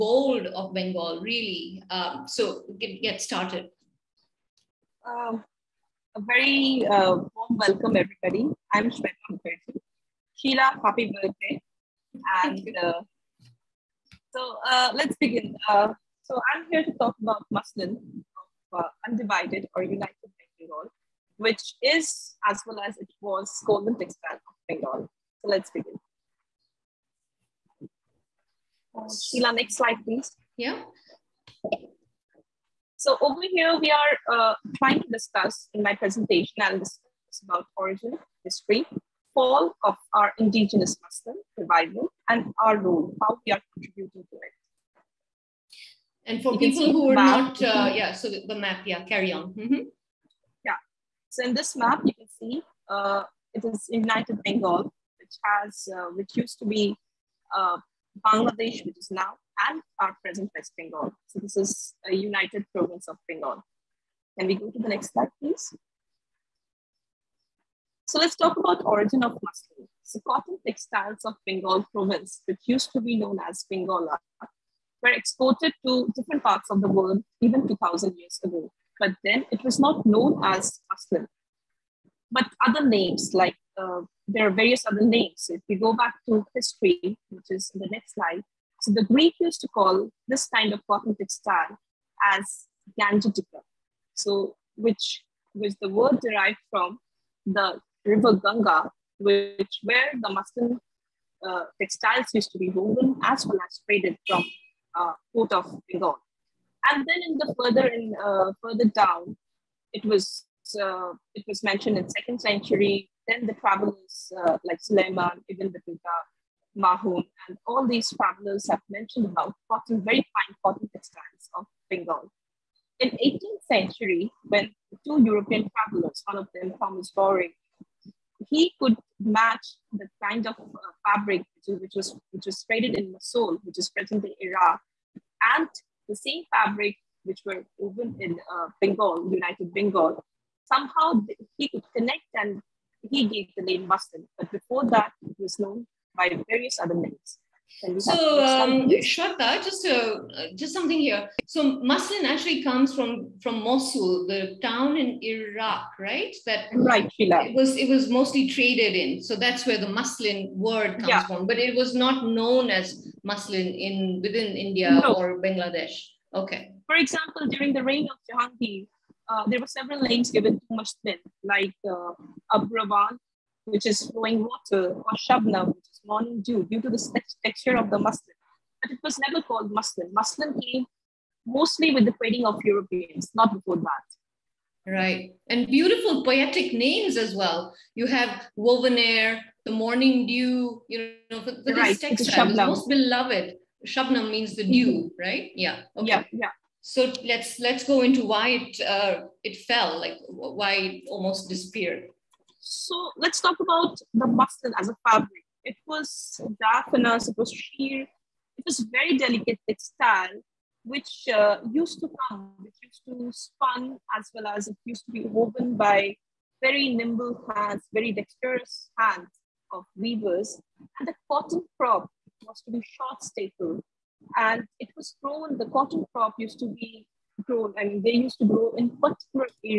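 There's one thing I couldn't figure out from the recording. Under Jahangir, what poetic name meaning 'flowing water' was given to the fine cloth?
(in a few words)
Abravan.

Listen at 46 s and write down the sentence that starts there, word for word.
And for you people who are not, uh, yeah, so the map, yeah, carry on.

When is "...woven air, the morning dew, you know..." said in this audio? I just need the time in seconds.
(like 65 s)
188 s.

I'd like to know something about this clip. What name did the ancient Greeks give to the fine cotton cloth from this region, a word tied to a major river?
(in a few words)
Gangetica.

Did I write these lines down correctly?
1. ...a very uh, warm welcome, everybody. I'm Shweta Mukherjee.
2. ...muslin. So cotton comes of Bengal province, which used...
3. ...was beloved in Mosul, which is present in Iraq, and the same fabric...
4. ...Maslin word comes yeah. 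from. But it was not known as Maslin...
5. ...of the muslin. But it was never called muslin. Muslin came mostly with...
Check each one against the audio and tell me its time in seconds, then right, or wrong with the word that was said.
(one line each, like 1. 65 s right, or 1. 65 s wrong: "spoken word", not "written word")
1. 6 s right
2. 69 s wrong: "textiles", not "comes"
3. 132 s wrong: "traded", not "beloved"
4. 159 s right
5. 177 s right.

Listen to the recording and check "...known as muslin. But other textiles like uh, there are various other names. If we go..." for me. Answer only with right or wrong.
wrong.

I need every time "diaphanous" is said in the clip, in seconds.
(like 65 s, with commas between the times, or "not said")
206 s.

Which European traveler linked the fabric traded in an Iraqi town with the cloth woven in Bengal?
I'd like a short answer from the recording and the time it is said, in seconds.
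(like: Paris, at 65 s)
Thomas Bowrey, at 126 s.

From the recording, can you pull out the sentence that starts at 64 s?
Can we go to the next slide, please?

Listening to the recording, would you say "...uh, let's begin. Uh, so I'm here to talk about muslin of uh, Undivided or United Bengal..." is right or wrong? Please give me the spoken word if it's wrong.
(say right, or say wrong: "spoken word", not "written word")
right.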